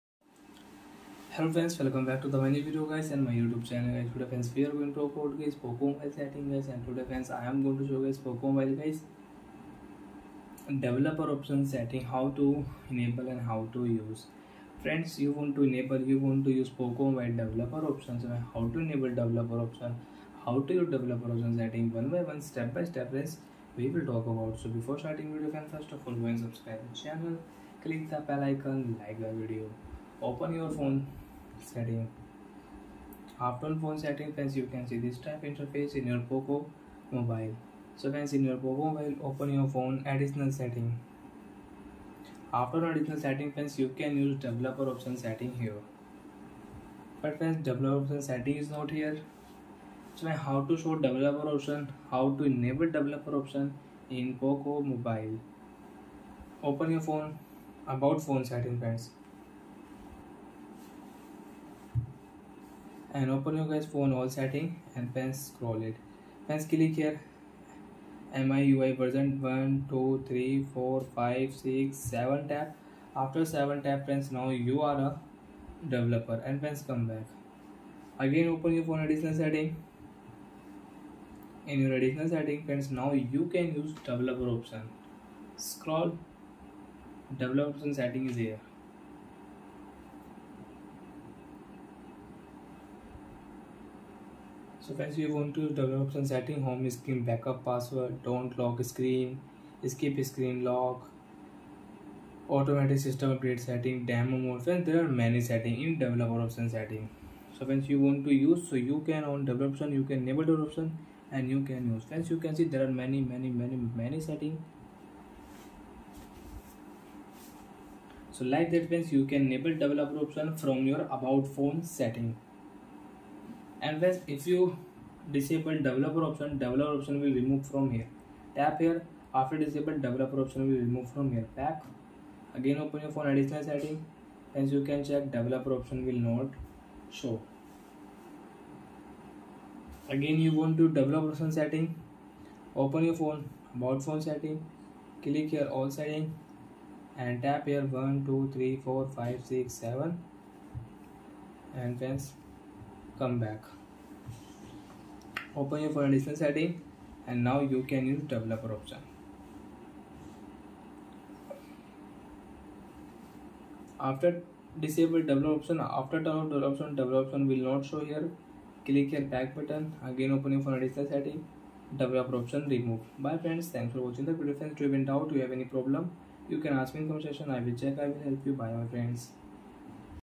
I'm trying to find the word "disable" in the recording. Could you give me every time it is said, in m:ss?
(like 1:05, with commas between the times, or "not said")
2:05, 2:09, 2:44.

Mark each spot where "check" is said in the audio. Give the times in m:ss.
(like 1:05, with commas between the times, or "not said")
2:15, 2:57.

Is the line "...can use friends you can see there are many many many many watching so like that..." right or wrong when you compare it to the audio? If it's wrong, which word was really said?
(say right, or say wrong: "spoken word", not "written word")
wrong: "setting", not "watching".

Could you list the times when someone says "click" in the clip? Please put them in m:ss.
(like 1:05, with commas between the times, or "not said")
0:27, 1:06, 2:25, 2:48.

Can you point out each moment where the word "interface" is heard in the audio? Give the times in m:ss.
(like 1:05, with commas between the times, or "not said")
0:35.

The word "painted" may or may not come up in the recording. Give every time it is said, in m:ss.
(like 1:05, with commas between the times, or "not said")
not said.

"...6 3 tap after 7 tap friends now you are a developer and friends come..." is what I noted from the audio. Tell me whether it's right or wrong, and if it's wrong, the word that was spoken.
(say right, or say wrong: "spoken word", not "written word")
wrong: "7", not "3".